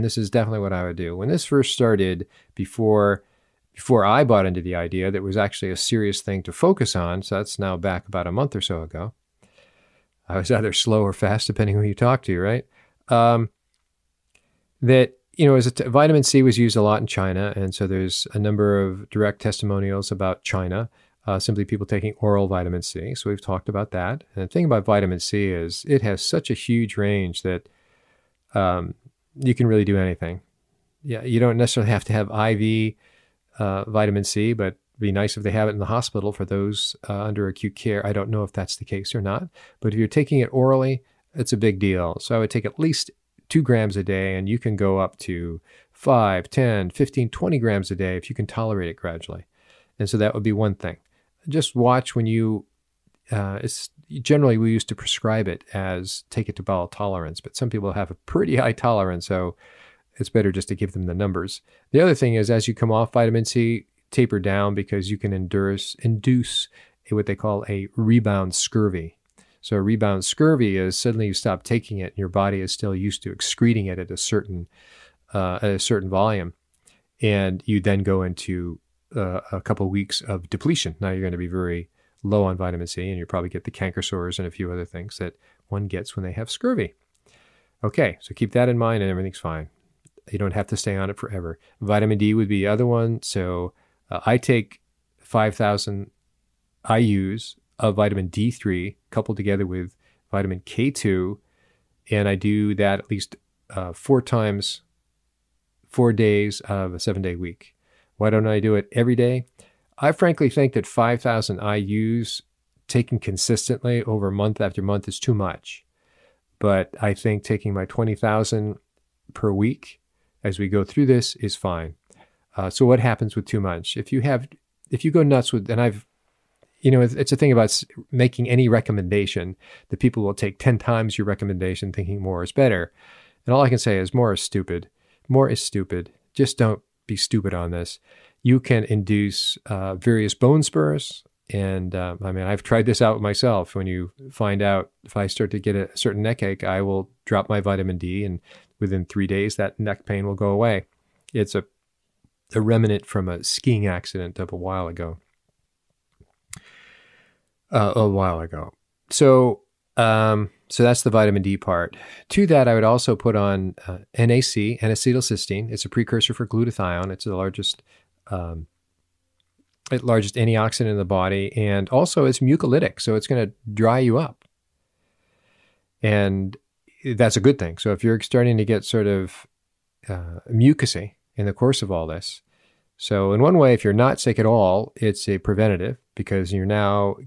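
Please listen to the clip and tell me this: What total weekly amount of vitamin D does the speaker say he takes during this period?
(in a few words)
20,000.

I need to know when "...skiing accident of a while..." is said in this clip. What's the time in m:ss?
2:33.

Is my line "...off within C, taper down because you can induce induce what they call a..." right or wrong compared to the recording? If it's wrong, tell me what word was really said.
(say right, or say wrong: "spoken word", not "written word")
wrong: "vitamin", not "within".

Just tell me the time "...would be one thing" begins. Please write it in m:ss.
0:50.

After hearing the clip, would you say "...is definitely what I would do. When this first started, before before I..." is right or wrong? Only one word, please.
right.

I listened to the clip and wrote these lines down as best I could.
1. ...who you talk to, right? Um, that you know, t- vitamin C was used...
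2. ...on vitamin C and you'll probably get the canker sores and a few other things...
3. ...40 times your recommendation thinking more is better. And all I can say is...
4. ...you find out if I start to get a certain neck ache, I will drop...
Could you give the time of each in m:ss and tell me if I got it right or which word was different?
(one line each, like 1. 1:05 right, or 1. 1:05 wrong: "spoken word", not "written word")
1. 0:11 right
2. 1:22 right
3. 2:10 wrong: "10", not "40"
4. 2:23 right.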